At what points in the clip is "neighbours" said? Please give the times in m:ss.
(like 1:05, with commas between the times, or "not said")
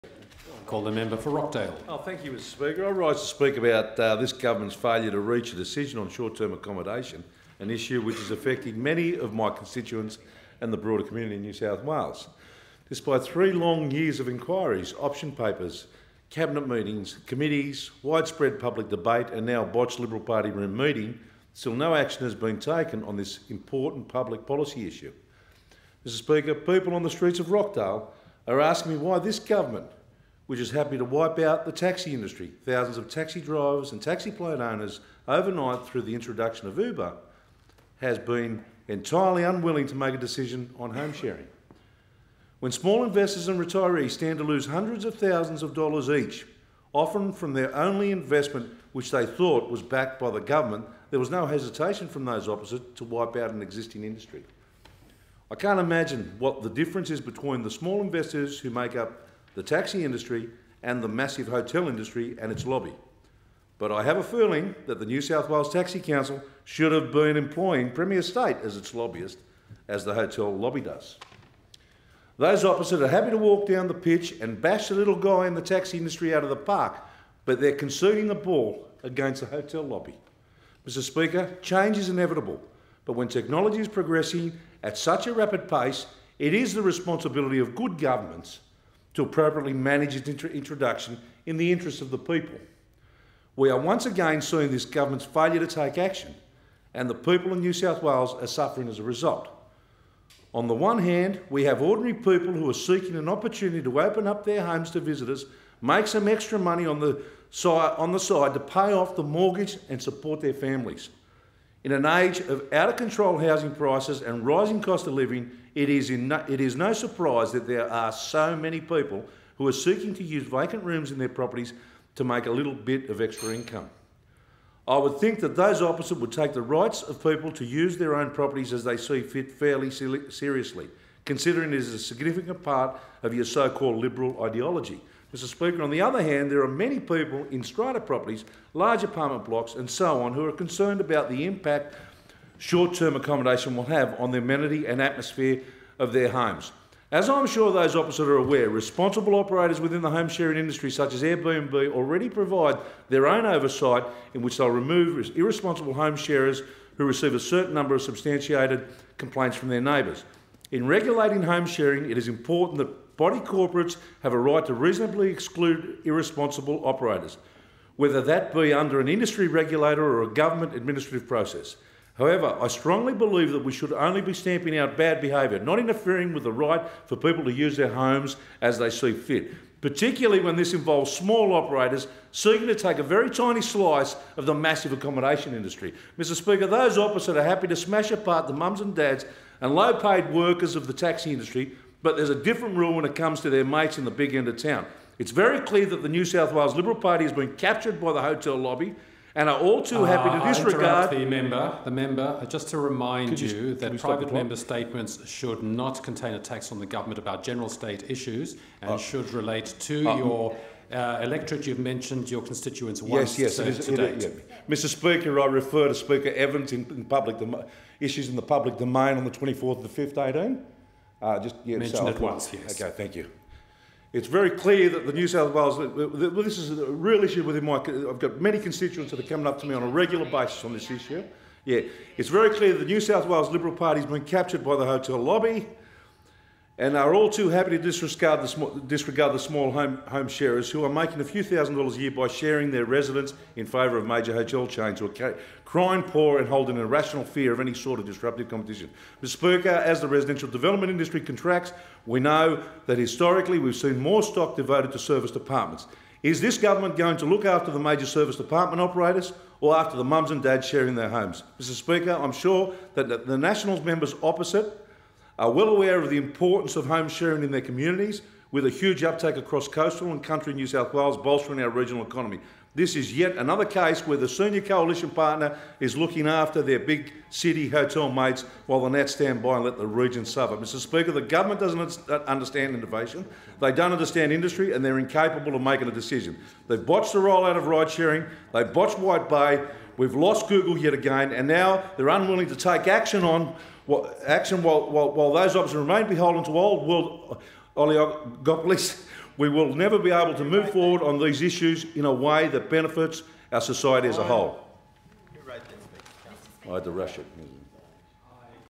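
2:39.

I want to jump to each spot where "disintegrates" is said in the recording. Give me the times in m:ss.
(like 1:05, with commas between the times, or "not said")
not said.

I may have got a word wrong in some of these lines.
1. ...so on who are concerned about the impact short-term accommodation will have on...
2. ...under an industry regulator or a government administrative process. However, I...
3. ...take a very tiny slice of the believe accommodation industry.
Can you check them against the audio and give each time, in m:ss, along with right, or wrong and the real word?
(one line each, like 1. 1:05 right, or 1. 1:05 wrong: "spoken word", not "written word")
1. 2:19 right
2. 2:48 right
3. 3:02 wrong: "massive", not "believe".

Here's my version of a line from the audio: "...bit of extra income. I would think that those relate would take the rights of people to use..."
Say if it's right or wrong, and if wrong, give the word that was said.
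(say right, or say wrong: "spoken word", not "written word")
wrong: "opposite", not "relate".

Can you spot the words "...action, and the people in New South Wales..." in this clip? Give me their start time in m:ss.
1:35.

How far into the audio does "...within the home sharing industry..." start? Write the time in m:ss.
2:29.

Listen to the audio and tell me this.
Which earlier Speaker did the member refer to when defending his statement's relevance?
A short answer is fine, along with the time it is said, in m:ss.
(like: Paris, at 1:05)
Speaker Evans, at 3:35.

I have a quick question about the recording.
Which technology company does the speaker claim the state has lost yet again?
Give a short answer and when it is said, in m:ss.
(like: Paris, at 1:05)
Google, at 4:50.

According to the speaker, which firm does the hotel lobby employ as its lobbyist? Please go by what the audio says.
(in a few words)
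Premier State.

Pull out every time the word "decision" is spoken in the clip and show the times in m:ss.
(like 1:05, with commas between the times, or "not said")
0:05, 0:40, 4:45.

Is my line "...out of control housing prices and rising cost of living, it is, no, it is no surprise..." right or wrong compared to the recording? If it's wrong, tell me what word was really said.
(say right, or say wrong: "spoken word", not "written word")
right.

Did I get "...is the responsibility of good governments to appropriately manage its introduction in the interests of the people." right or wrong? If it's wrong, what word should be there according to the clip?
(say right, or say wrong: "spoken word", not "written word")
right.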